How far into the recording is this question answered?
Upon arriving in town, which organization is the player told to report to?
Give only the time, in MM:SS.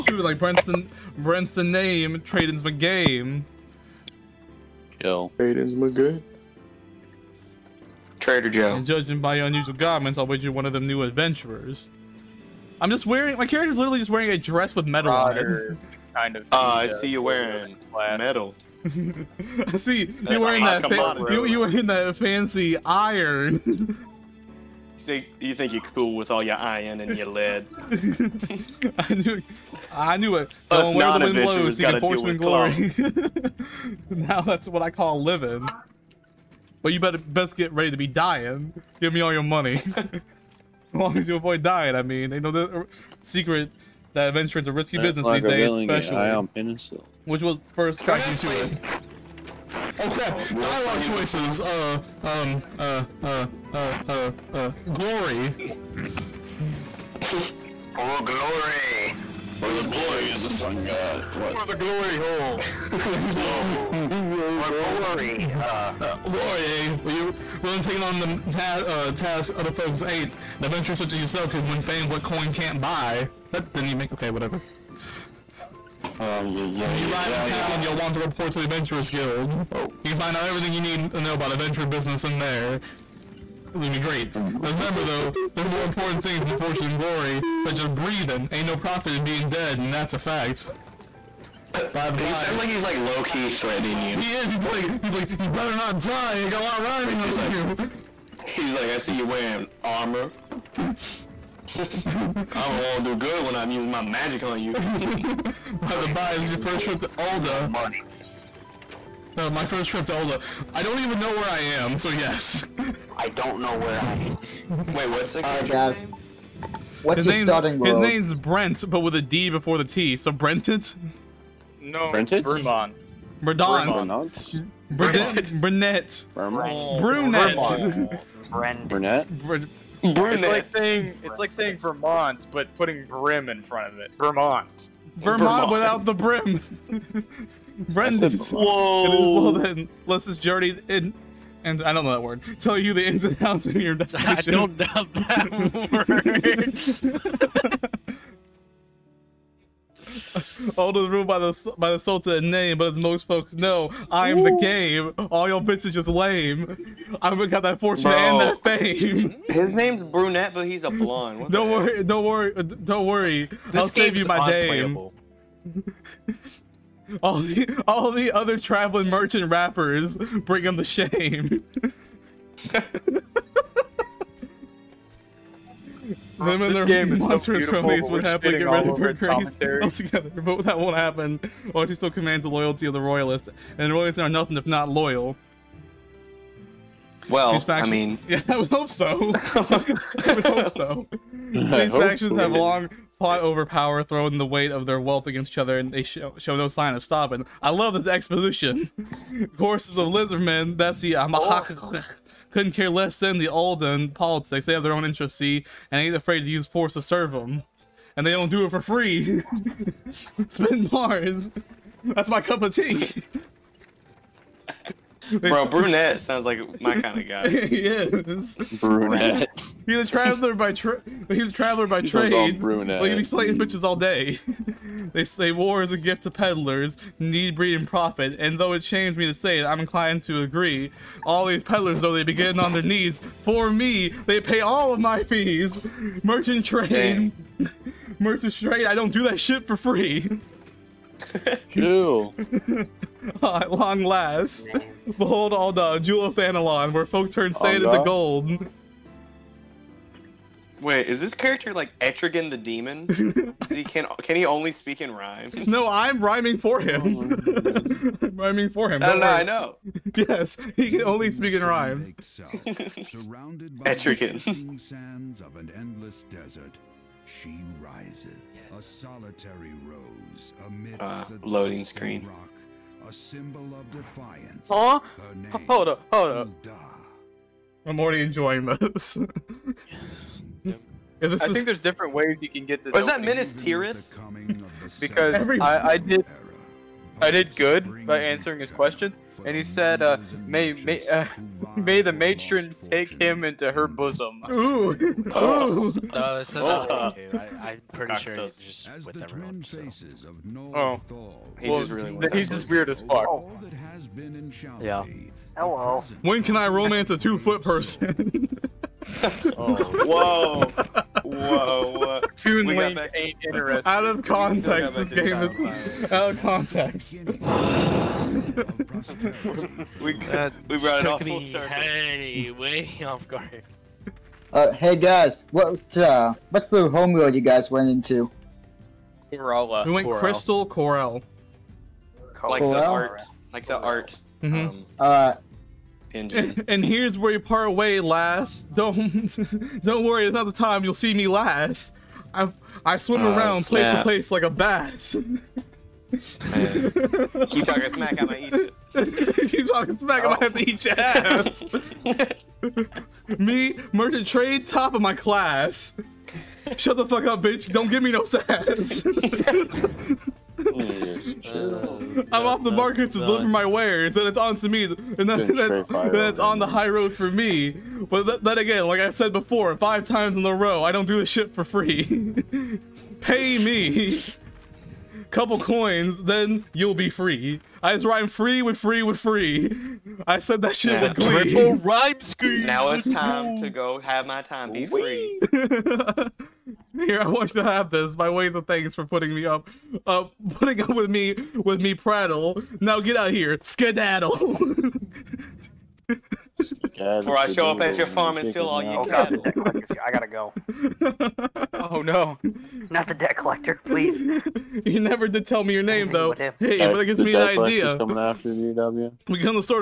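01:18.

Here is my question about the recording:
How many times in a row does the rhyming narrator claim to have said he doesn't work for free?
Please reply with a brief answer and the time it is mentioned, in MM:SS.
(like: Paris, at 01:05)
5, at 06:09.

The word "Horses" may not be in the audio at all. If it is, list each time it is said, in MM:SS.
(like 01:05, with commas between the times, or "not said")
03:19.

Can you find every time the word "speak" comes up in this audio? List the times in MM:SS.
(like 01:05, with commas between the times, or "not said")
04:14, 04:21.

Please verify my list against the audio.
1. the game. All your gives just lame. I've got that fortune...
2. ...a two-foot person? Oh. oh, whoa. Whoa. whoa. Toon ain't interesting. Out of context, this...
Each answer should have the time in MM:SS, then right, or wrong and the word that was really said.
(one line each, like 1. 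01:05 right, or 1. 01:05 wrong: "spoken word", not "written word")
1. 02:34 wrong: "bitches", not "gives"
2. 05:07 right.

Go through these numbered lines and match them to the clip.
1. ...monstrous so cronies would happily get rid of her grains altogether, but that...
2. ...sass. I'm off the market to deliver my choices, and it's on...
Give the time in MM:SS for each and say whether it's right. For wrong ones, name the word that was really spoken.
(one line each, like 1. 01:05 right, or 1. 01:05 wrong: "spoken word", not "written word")
1. 02:57 right
2. 05:58 wrong: "wares", not "choices".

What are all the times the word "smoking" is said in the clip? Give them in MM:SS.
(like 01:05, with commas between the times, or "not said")
not said.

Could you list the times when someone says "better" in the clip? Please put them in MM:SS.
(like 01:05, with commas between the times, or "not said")
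00:36, 01:35.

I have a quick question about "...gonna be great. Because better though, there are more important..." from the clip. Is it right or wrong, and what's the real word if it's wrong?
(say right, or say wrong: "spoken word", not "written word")
wrong: "remember", not "better".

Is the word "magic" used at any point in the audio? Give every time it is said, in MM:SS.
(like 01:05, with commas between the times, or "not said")
01:44.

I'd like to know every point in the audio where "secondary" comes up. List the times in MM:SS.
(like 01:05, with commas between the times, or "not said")
not said.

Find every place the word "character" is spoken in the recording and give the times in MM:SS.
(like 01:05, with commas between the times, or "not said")
00:13, 04:11.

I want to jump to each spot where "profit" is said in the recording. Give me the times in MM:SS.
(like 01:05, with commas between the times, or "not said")
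01:28, 03:47.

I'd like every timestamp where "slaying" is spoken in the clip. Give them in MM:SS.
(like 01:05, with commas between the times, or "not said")
03:43.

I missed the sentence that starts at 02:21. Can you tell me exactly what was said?
And I don't know that word.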